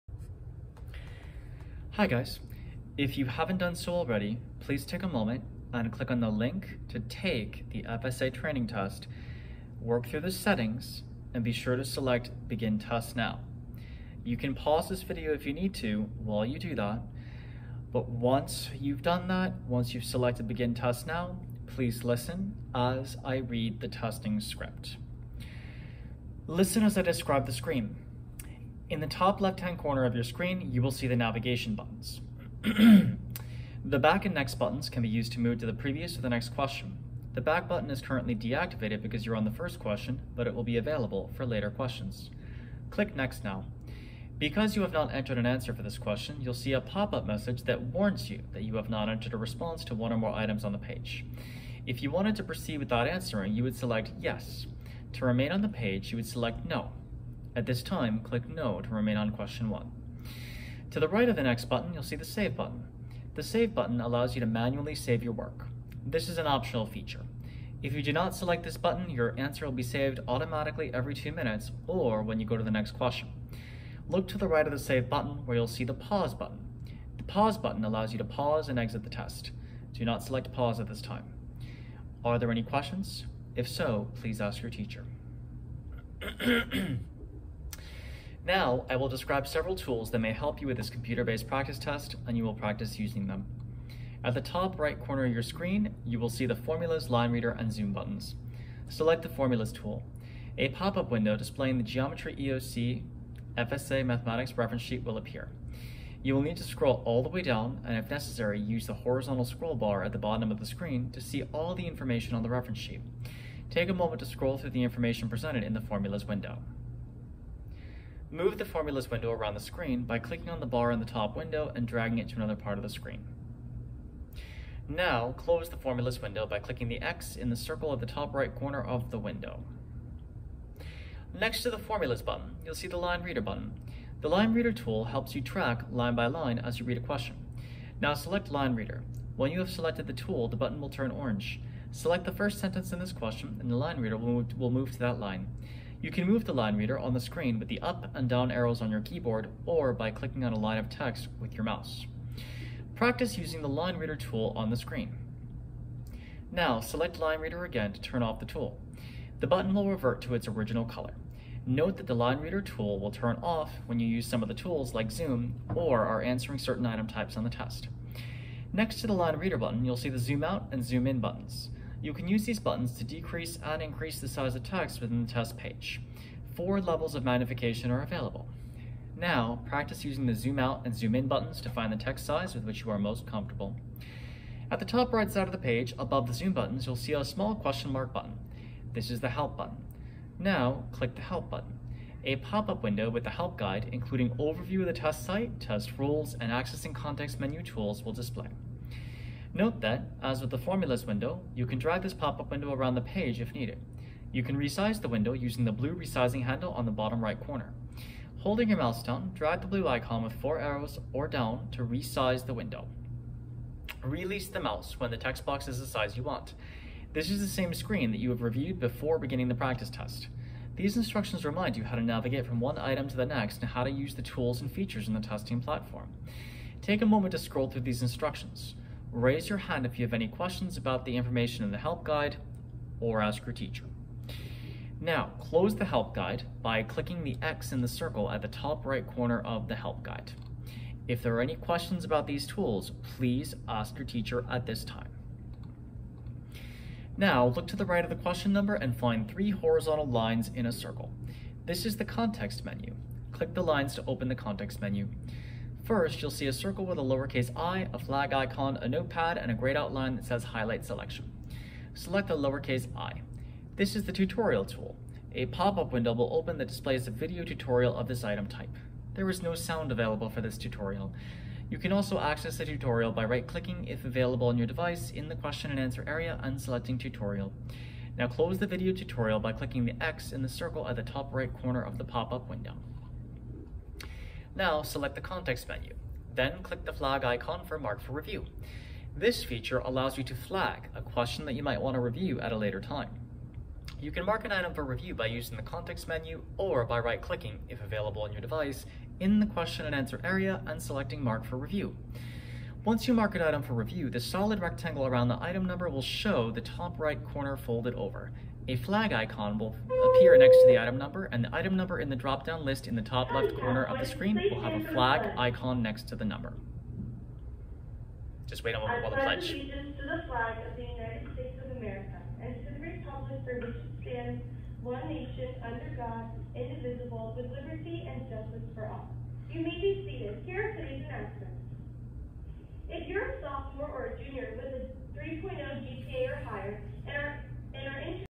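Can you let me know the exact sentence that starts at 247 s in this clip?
Now, look to the right of the question number and find three horizontal lines in a circle.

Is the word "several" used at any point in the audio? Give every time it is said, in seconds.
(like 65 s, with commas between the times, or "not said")
89 s.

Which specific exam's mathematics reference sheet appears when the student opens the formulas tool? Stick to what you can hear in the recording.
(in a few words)
Geometry EOC FSA.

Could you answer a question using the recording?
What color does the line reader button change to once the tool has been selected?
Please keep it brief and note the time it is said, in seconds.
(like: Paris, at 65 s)
orange, at 141 s.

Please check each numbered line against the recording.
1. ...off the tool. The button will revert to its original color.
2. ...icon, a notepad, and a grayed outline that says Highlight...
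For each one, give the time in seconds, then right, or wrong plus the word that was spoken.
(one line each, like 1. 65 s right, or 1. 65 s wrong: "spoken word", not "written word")
1. 158 s right
2. 258 s right.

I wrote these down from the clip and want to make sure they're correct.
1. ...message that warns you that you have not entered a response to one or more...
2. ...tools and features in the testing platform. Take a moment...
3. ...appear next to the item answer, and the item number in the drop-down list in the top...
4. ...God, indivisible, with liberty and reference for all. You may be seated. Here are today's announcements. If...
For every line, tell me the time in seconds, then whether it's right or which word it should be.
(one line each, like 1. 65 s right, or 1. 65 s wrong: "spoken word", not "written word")
1. 47 s right
2. 224 s right
3. 310 s wrong: "number", not "answer"
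4. 325 s wrong: "justice", not "reference".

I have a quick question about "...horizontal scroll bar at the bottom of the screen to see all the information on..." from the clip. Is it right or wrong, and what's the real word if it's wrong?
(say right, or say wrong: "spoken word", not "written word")
right.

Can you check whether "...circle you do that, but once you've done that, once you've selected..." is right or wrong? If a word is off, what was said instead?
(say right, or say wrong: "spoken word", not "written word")
wrong: "while", not "circle".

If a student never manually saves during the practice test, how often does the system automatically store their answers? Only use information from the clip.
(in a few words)
every two minutes.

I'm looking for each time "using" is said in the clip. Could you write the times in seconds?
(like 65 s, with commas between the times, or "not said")
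92 s, 153 s, 180 s, 205 s, 295 s.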